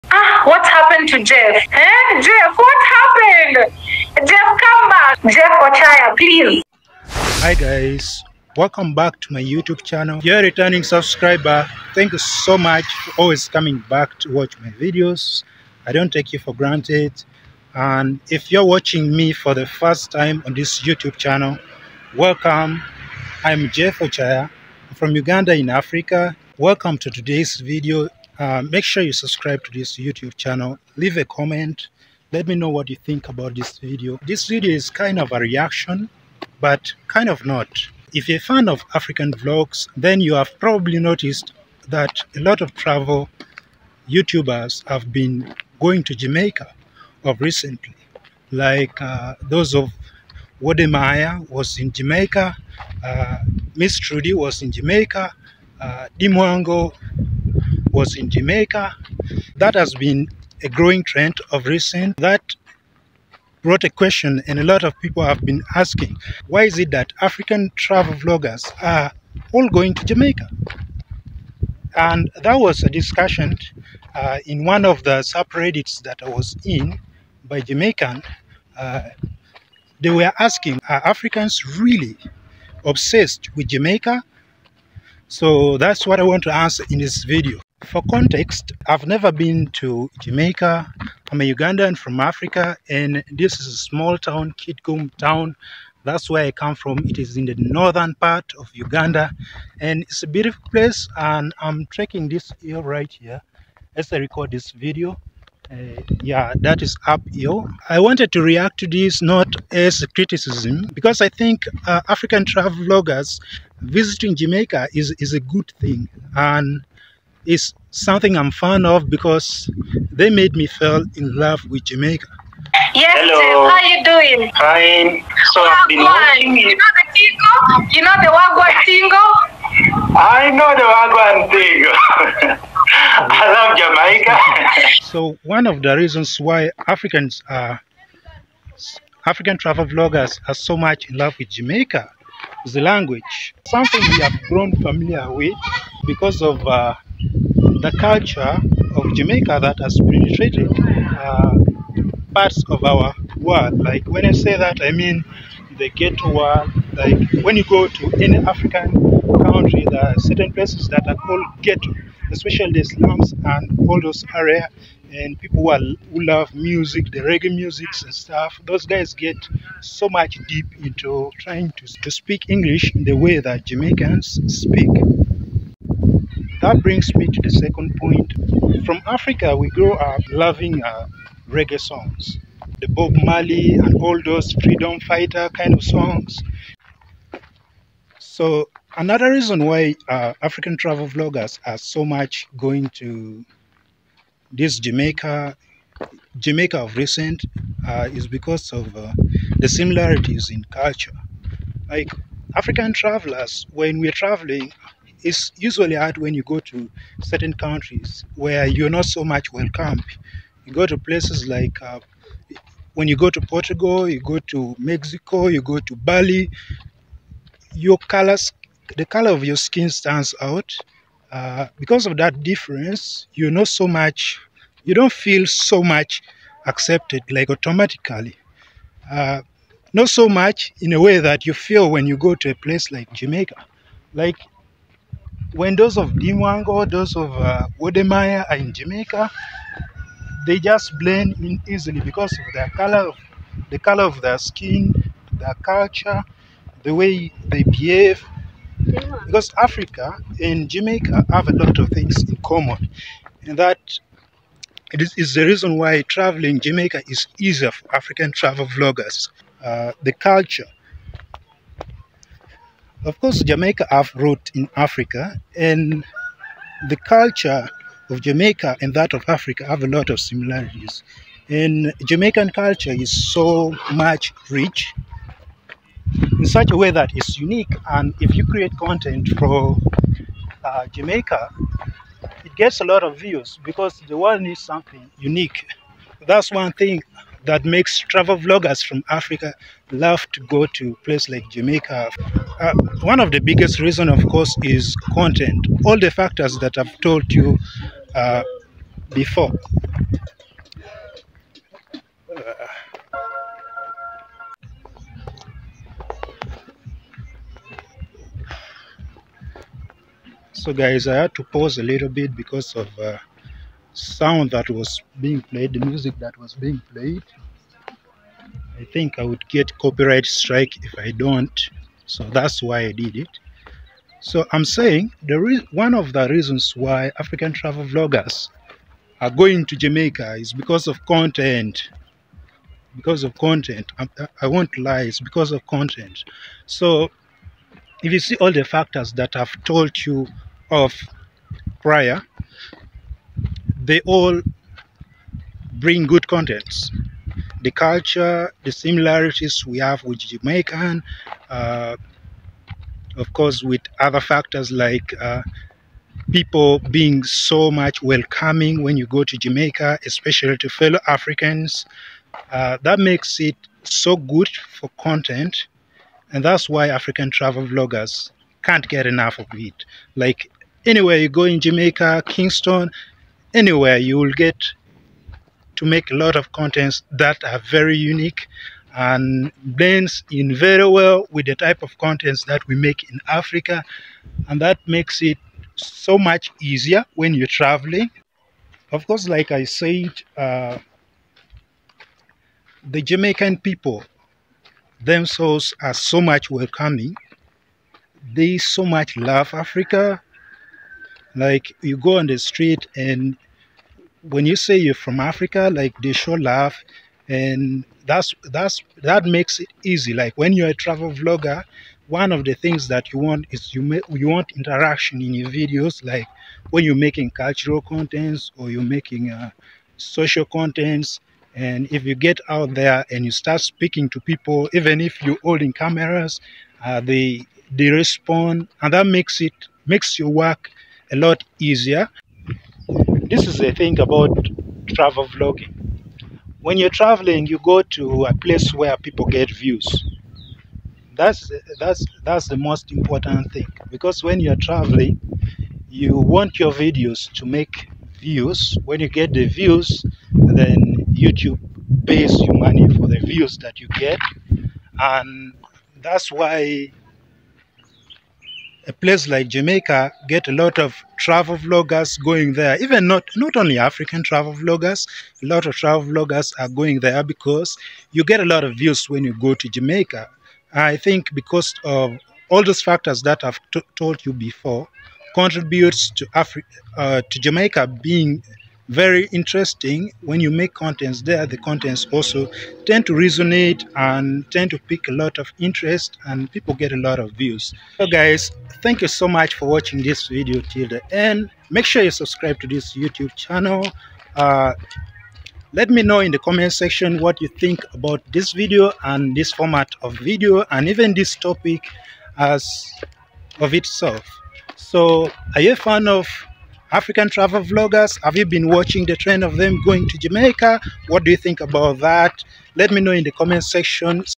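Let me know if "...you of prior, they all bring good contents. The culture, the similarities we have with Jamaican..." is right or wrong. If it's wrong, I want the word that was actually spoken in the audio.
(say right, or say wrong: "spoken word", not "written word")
right.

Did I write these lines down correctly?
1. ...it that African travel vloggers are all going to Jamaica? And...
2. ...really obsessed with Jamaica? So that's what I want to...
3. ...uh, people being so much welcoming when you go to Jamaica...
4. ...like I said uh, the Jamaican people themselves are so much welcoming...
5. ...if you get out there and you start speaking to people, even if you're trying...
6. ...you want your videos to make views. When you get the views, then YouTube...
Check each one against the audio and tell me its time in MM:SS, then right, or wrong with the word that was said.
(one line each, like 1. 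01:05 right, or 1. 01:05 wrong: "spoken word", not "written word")
1. 01:06 right
2. 01:21 right
3. 05:55 right
4. 06:29 right
5. 07:01 wrong: "holding", not "trying"
6. 07:25 right.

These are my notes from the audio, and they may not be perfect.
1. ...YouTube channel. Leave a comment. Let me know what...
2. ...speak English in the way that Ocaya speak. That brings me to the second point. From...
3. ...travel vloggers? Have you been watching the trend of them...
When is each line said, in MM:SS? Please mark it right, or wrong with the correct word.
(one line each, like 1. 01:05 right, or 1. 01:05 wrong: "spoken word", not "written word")
1. 00:29 right
2. 02:52 wrong: "Jamaicans", not "Ocaya"
3. 08:27 right.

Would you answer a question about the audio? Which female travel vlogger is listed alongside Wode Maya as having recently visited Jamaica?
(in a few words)
Miss Trudy.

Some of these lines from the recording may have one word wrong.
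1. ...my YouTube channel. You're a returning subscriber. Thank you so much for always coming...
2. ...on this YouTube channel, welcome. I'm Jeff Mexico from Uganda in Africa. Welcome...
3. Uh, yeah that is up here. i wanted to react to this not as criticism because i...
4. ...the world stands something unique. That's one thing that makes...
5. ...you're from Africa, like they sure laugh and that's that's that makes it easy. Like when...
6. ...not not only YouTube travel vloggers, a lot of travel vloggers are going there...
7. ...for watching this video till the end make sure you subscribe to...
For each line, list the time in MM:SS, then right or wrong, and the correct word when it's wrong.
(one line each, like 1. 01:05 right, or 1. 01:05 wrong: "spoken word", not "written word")
1. 00:09 right
2. 00:20 wrong: "Ocaya", not "Mexico"
3. 01:45 right
4. 04:44 wrong: "needs", not "stands"
5. 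06:44 right
6. 07:43 wrong: "African", not "YouTube"
7. 08:09 right.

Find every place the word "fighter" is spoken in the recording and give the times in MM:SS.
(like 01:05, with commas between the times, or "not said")
03:04.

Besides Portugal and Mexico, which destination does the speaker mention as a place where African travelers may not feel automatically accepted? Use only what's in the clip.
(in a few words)
Bali.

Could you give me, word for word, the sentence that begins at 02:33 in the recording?
Like when I say that, I mean the ghetto world.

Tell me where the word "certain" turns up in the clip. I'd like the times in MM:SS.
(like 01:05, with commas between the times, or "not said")
02:40, 03:27.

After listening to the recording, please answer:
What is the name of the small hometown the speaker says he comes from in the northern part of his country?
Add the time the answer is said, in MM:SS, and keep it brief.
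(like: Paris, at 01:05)
Kitgum, at 01:34.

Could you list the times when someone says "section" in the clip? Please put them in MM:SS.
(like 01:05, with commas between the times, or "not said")
08:16, 08:33.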